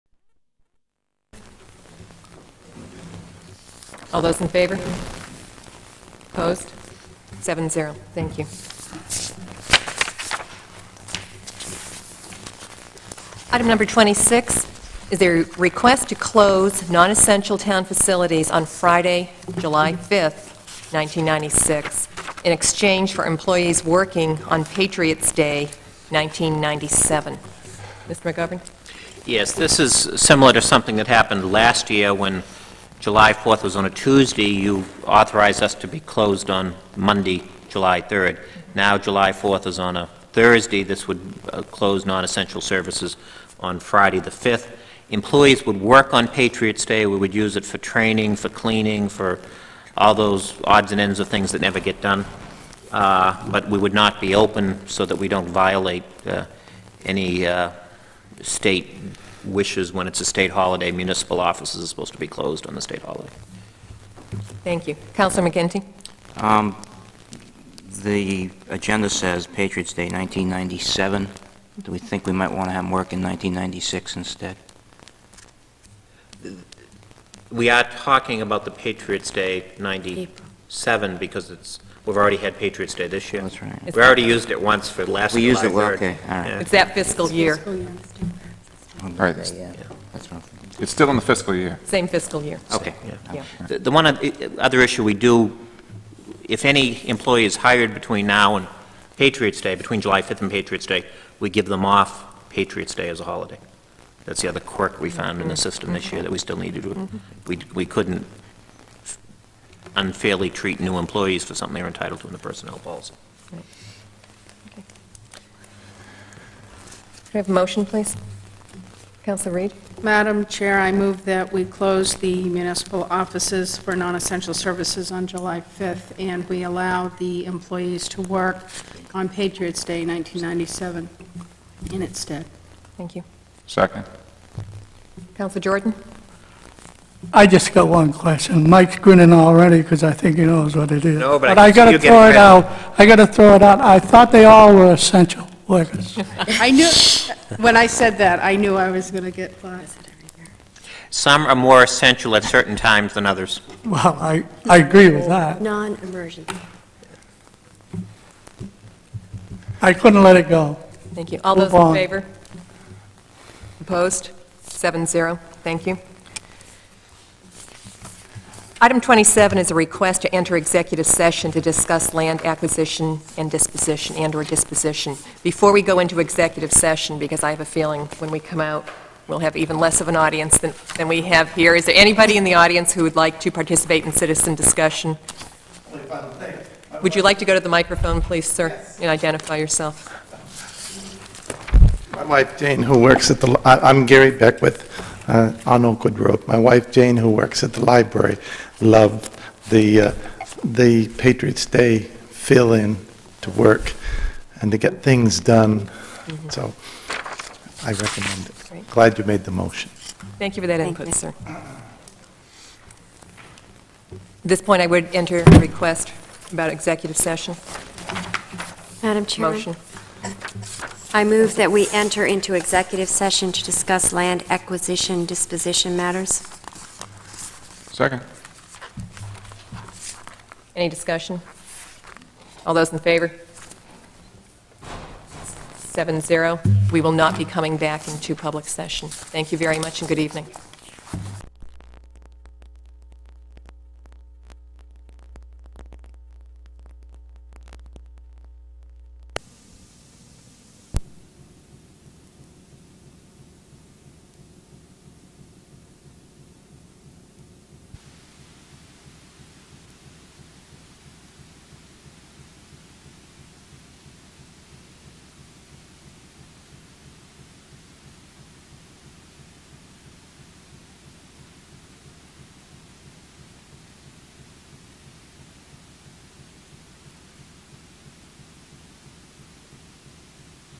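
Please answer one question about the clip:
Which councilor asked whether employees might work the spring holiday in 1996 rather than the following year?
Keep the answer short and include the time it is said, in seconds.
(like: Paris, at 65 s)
Councilor McGinty, at 65 s.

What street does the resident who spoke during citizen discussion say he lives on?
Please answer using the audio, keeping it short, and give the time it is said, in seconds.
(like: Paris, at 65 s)
Oakwood Road, at 195 s.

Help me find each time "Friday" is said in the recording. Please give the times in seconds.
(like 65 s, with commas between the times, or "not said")
18 s, 43 s.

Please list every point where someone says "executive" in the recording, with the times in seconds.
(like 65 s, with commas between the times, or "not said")
170 s, 176 s, 216 s, 222 s.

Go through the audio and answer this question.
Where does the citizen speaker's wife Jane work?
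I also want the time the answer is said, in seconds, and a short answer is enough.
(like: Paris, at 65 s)
the library, at 197 s.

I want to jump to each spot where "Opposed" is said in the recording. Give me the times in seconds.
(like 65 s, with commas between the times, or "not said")
6 s, 163 s.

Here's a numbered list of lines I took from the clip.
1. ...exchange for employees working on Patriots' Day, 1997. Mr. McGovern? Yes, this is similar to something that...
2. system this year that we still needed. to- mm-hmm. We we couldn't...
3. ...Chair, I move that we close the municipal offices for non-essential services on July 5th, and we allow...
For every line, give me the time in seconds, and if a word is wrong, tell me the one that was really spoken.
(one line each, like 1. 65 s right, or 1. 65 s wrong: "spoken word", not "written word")
1. 22 s right
2. 105 s right
3. 120 s right.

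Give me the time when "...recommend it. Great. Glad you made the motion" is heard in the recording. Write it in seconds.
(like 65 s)
207 s.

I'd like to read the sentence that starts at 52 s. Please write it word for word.
Uh, but we would not be open so that we don't violate uh, any uh, state wishes when it's a state holiday.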